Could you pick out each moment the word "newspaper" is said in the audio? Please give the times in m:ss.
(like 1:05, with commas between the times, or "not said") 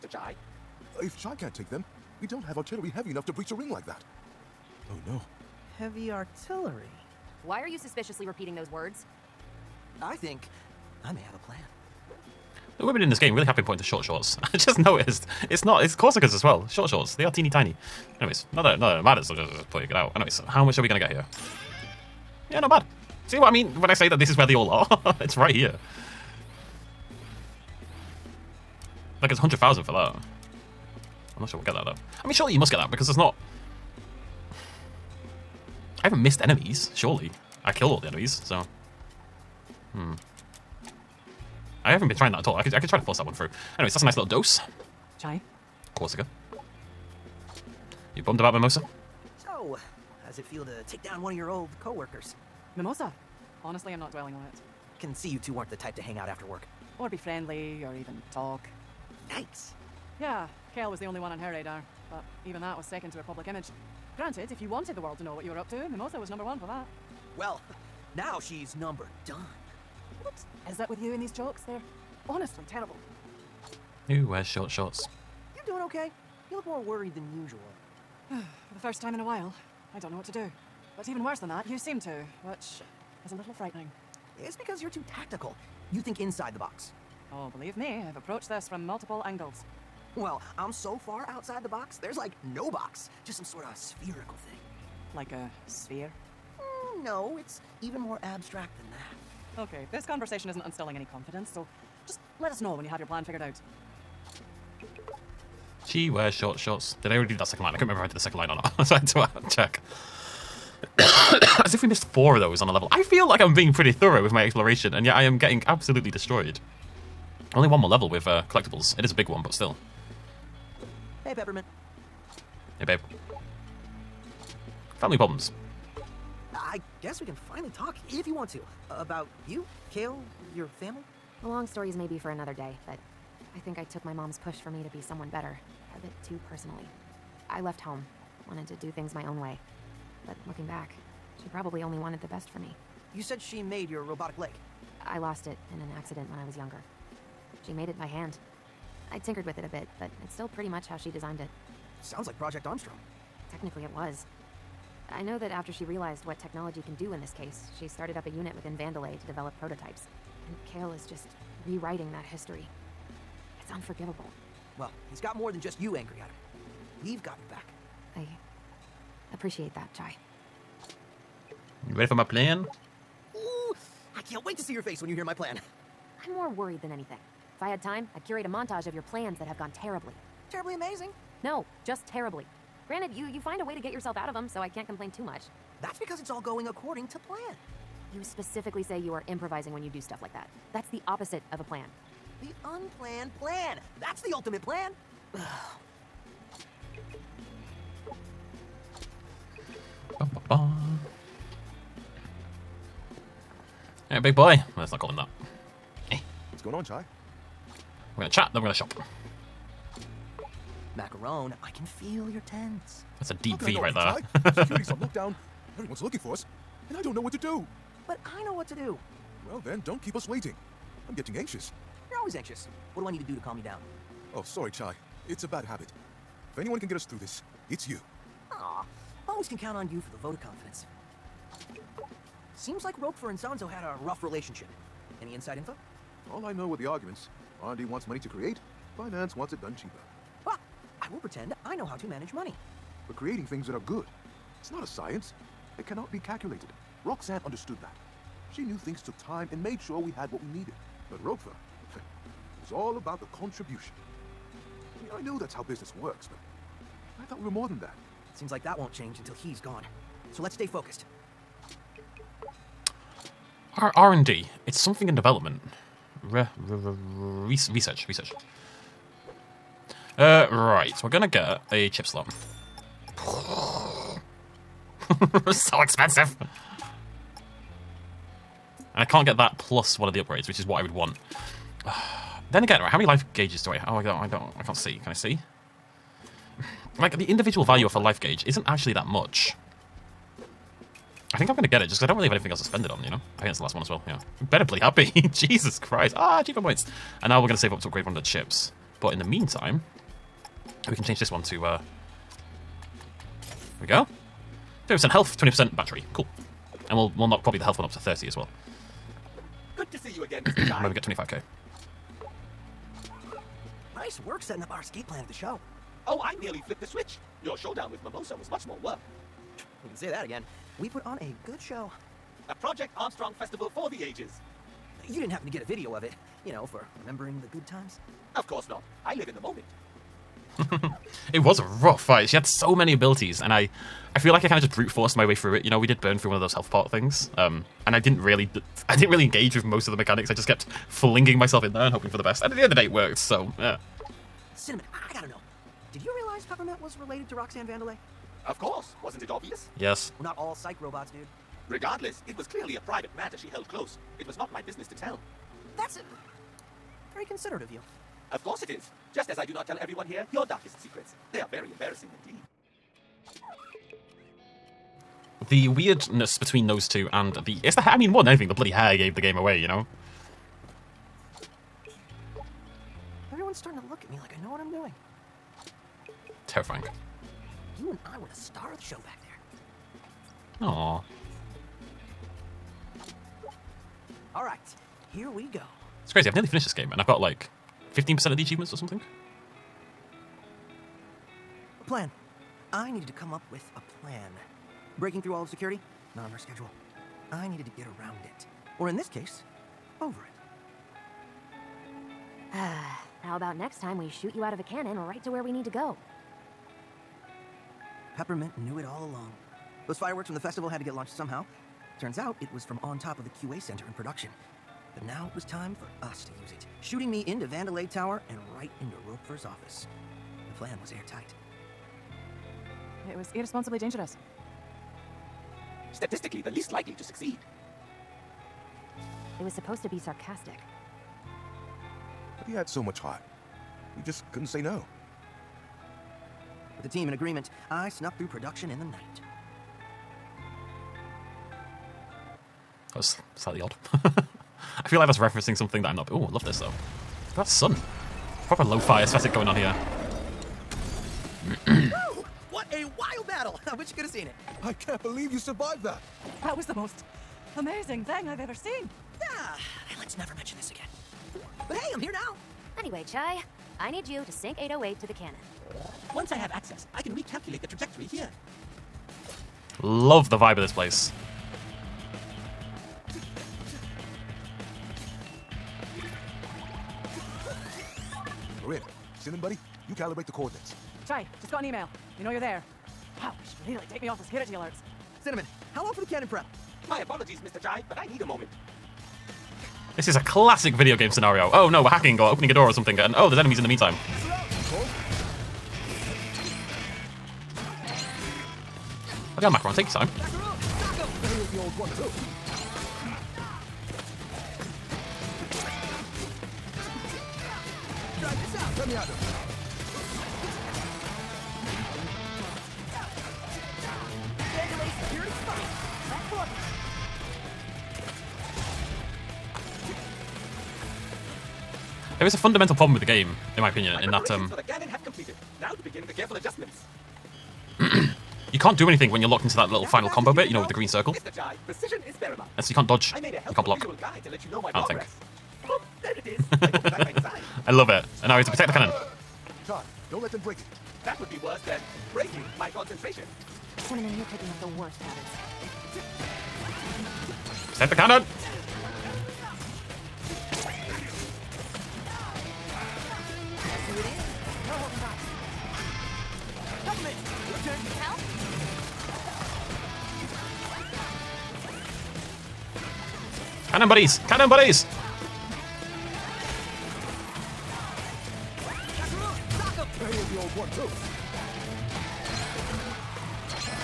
not said.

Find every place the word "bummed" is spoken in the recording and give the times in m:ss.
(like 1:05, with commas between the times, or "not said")
0:48.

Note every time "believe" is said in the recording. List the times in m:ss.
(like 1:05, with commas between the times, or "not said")
1:27, 7:35.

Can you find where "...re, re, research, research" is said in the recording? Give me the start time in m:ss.
4:26.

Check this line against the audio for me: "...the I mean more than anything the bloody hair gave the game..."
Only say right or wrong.
right.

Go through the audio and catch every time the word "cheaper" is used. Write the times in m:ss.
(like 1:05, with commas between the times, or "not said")
3:59, 4:56.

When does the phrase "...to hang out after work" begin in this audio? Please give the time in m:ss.
0:55.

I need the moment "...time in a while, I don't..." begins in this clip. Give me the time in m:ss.
1:19.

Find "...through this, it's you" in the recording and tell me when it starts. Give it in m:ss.
3:47.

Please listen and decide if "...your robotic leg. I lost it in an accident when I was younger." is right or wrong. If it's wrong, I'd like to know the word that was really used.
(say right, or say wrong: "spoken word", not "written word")
right.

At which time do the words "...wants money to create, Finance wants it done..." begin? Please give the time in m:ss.
3:57.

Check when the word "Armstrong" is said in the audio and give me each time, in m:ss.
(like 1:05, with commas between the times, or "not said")
2:32, 5:22.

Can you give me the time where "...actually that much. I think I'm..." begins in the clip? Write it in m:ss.
4:48.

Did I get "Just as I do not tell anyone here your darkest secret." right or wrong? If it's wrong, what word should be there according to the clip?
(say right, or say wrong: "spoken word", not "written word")
wrong: "everyone", not "anyone".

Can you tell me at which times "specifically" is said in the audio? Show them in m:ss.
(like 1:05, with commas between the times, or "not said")
3:08.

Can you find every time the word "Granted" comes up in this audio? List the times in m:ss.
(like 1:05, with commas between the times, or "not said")
1:04, 3:02.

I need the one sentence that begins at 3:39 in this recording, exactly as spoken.
Well then, don't keep us waiting.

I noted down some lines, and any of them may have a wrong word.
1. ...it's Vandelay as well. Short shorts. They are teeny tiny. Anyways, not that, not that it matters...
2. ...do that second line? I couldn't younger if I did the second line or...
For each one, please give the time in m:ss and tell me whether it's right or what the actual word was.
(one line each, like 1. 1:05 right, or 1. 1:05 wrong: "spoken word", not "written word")
1. 0:15 wrong: "Corsicans", not "Vandelay"
2. 1:47 wrong: "remember", not "younger".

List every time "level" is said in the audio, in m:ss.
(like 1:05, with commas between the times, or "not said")
1:52, 1:57.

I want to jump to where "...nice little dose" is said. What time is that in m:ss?
0:44.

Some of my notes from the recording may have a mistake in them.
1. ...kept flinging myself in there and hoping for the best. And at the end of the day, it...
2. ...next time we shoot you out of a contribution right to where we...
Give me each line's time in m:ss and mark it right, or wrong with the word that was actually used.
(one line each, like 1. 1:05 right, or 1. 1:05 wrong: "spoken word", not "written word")
1. 5:40 right
2. 6:43 wrong: "cannon", not "contribution".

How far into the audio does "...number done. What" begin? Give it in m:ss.
1:08.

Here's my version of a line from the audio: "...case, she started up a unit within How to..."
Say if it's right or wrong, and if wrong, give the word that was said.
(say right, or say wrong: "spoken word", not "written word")
wrong: "Vandelay", not "How".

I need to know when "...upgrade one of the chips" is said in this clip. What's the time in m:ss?
4:57.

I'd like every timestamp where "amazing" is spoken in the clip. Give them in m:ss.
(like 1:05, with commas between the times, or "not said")
3:00, 7:37.